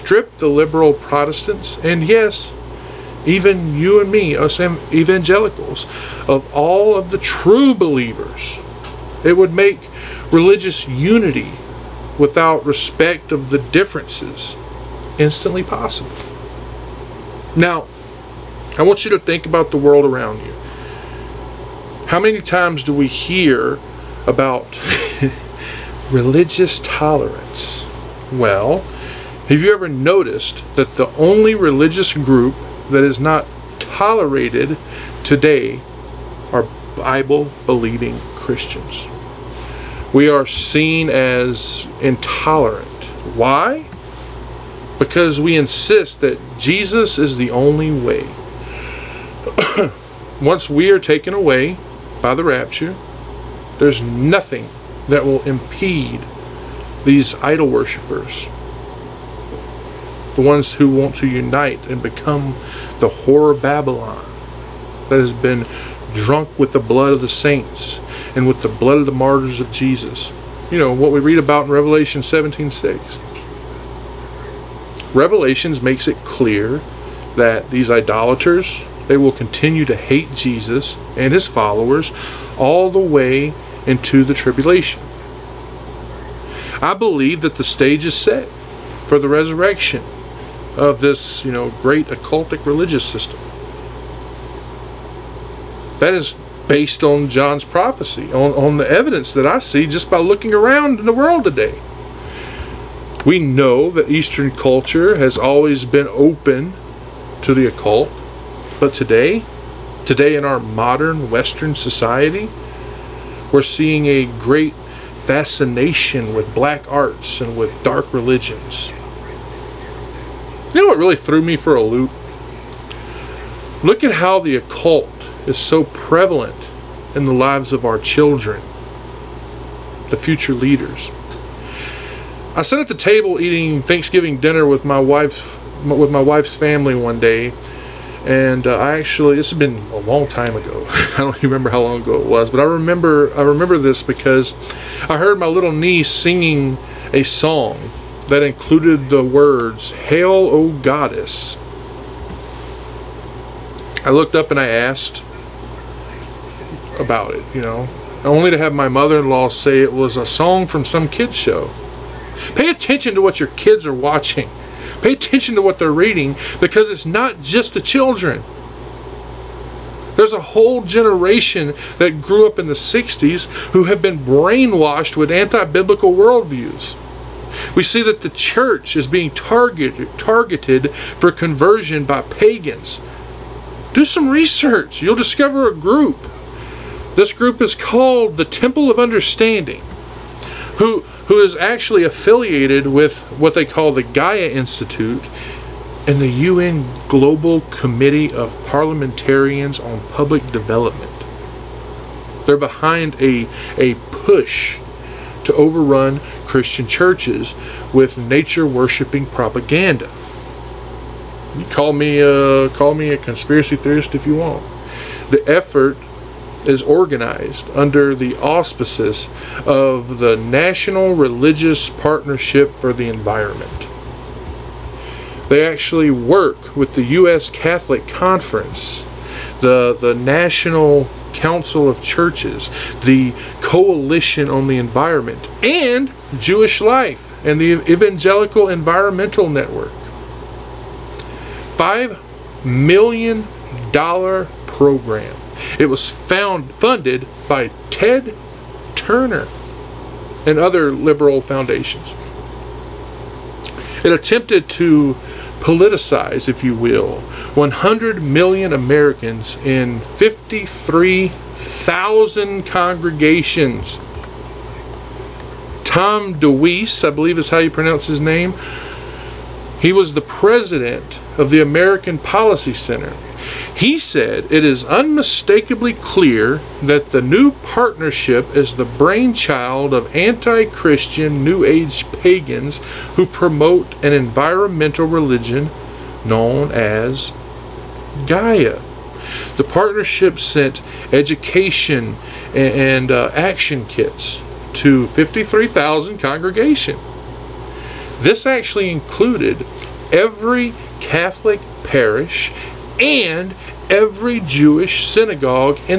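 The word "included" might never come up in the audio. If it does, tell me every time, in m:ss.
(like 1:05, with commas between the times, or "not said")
2:28, 4:58.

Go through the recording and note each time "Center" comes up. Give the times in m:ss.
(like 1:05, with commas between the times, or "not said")
4:32.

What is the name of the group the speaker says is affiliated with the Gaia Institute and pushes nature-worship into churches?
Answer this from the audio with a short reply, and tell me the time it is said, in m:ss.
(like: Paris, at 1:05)
Temple of Understanding, at 3:08.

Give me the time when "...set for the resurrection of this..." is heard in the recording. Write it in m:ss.
1:28.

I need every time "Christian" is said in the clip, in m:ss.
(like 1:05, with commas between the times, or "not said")
0:38, 3:26, 4:40.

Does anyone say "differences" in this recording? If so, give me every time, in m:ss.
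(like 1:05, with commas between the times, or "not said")
0:13.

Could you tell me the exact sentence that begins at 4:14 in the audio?
It attempted to politicize, if you will, 100 million Americans in 53,000 congregations.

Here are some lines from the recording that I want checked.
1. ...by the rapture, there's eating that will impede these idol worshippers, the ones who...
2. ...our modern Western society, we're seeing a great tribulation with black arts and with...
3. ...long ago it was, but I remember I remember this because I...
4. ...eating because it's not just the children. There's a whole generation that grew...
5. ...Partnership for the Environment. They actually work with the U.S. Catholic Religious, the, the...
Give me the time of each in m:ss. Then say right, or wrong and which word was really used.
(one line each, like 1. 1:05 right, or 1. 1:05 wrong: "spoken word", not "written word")
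1. 0:52 wrong: "nothing", not "eating"
2. 1:50 wrong: "fascination", not "tribulation"
3. 2:21 right
4. 2:45 wrong: "reading", not "eating"
5. 3:41 wrong: "Conference", not "Religious".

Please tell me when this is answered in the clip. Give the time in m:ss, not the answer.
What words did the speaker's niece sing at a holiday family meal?
2:29.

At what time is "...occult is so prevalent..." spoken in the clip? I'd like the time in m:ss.
2:04.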